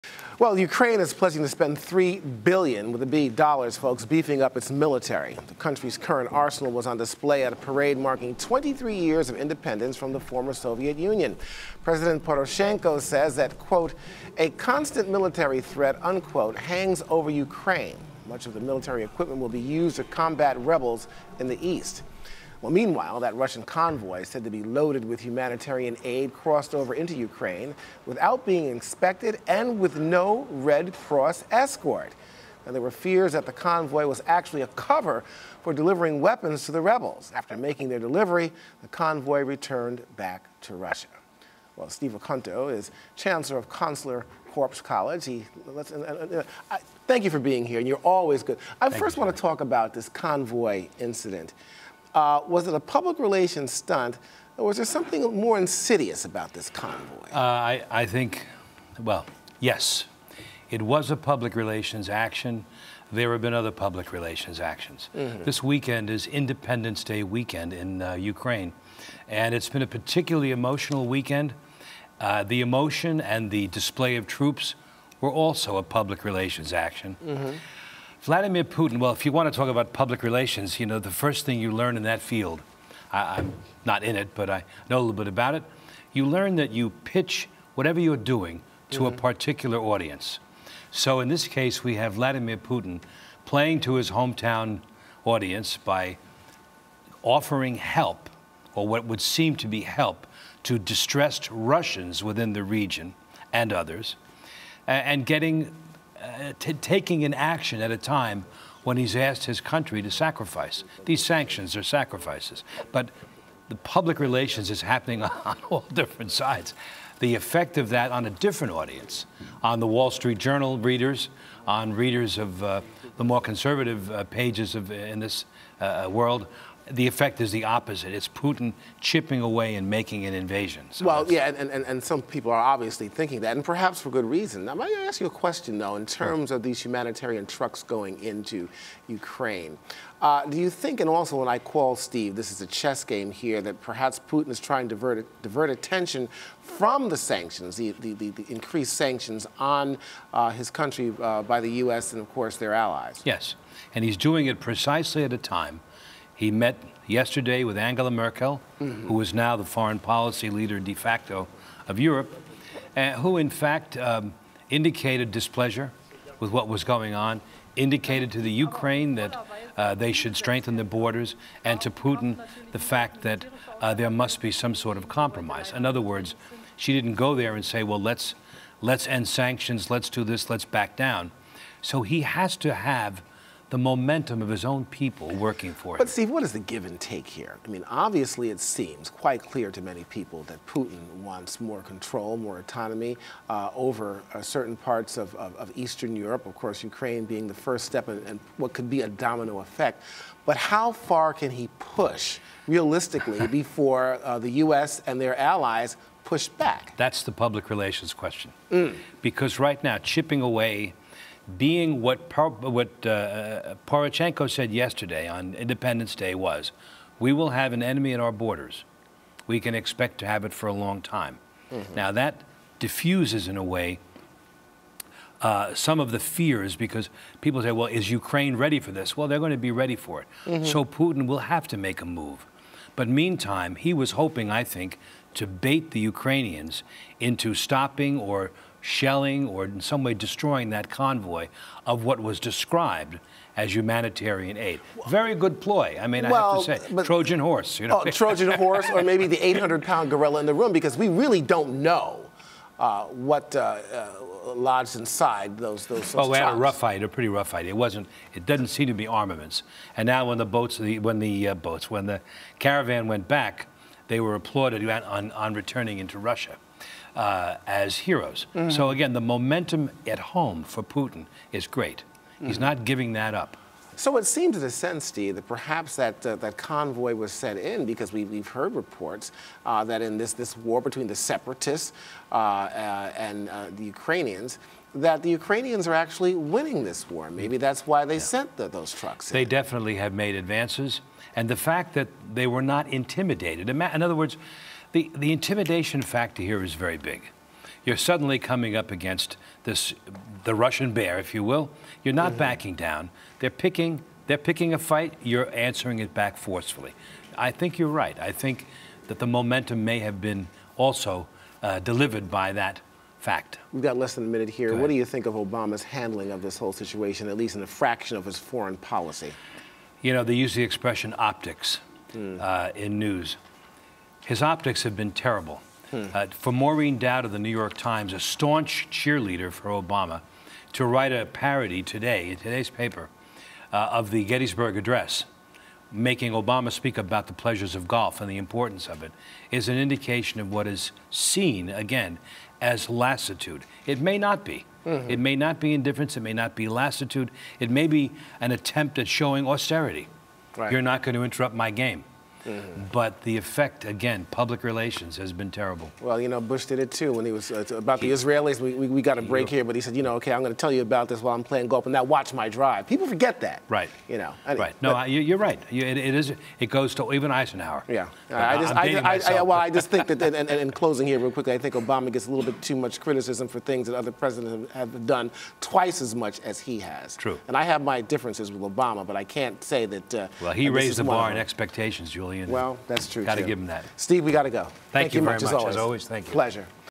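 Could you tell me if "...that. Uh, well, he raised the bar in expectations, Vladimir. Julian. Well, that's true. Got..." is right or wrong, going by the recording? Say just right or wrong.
wrong.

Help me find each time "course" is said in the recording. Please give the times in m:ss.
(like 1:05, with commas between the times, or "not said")
2:32, 3:16.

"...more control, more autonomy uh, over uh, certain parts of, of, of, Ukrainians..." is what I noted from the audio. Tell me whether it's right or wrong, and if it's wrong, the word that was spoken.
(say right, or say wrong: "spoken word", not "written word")
wrong: "Eastern", not "Ukrainians".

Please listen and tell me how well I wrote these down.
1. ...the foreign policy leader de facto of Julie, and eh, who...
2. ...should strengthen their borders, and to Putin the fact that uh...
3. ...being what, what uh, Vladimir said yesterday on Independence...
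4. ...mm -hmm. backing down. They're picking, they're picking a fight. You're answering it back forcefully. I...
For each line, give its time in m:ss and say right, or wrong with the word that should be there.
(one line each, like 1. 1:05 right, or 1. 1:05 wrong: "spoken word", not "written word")
1. 2:39 wrong: "Europe", not "Julie"
2. 2:50 right
3. 3:31 wrong: "Poroshenko", not "Vladimir"
4. 5:02 right.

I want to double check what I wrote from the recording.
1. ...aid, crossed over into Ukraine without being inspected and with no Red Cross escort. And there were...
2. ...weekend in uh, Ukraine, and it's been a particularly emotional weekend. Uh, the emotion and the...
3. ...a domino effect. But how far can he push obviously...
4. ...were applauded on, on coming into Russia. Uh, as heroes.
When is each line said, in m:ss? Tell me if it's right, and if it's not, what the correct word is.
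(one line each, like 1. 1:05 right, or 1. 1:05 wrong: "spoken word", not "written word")
1. 0:26 right
2. 1:07 right
3. 3:19 wrong: "realistically", not "obviously"
4. 4:24 wrong: "returning", not "coming".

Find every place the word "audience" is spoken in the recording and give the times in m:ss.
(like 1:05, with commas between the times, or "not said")
1:29, 1:35, 1:58.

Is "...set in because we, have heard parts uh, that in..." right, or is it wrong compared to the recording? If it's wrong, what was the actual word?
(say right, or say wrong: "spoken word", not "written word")
wrong: "reports", not "parts".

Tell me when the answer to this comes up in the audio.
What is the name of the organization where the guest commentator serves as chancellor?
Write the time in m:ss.
0:43.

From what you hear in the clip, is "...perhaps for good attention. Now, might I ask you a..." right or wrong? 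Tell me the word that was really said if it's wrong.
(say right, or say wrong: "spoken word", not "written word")
wrong: "reason", not "attention".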